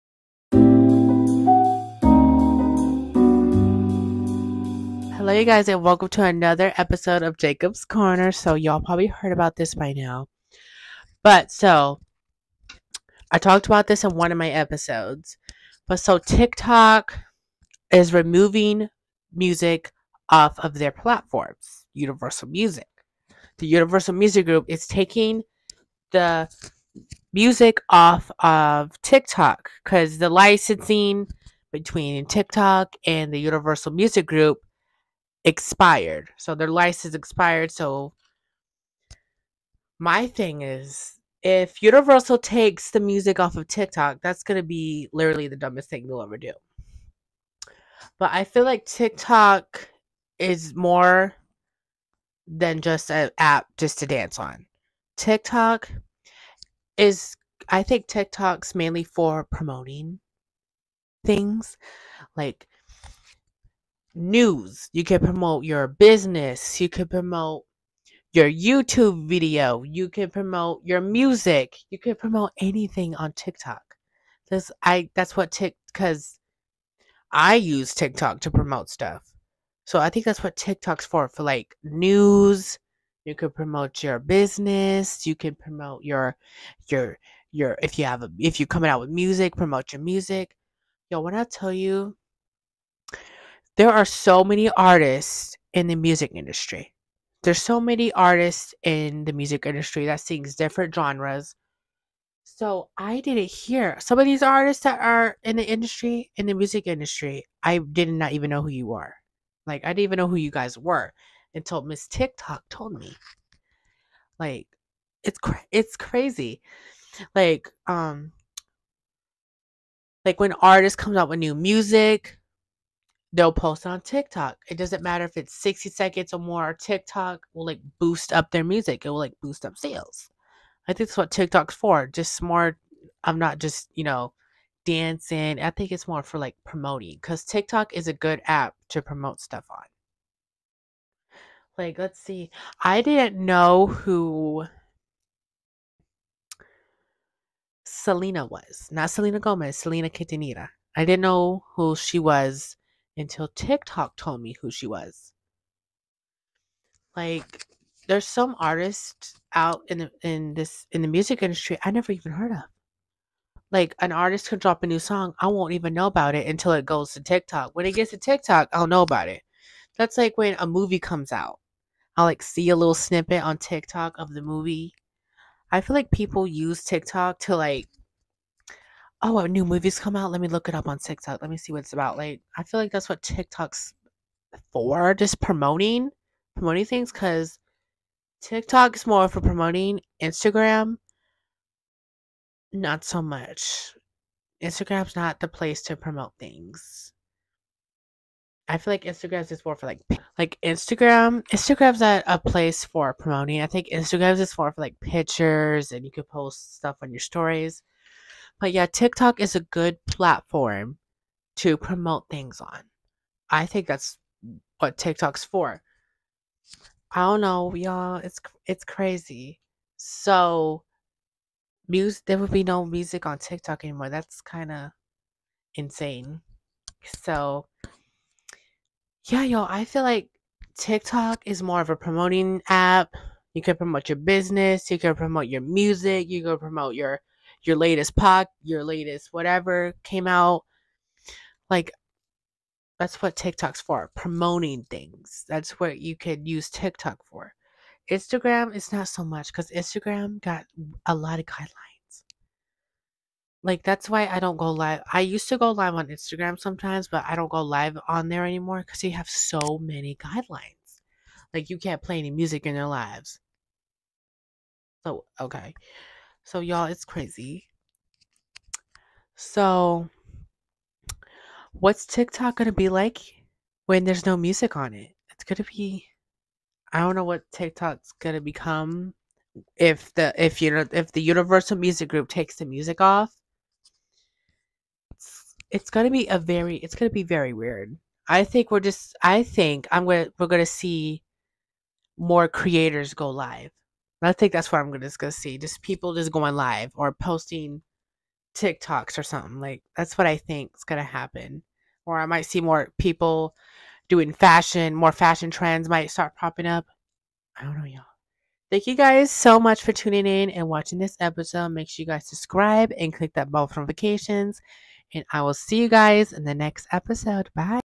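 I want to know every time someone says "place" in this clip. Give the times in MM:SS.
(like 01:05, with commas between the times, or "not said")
03:15, 03:22.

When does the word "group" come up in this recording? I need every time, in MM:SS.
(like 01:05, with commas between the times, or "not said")
00:24, 00:34, 04:42.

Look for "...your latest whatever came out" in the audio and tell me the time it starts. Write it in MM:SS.
03:58.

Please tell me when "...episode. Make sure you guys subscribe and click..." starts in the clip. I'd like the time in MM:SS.
05:11.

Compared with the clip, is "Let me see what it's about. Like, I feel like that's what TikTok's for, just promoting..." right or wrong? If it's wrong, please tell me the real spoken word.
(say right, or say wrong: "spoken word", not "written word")
right.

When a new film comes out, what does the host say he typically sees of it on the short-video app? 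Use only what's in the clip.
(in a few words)
a little snippet.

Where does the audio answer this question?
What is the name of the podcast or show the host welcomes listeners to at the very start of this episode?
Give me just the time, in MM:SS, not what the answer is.
00:07.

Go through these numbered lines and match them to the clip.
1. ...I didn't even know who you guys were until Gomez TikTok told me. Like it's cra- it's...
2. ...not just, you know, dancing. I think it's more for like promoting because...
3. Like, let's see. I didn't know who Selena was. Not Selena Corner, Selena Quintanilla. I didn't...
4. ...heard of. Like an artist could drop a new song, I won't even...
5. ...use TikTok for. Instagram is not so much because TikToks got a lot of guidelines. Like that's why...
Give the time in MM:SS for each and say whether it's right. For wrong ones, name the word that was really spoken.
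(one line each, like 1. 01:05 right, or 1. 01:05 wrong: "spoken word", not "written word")
1. 01:49 wrong: "Miss", not "Gomez"
2. 02:13 right
3. 02:21 wrong: "Gomez", not "Corner"
4. 02:42 right
5. 04:06 wrong: "Instagram", not "TikToks".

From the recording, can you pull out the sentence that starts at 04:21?
Like you can't play any music in their lives.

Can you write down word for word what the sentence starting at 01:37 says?
There's so many artists in the music industry that sings different genres.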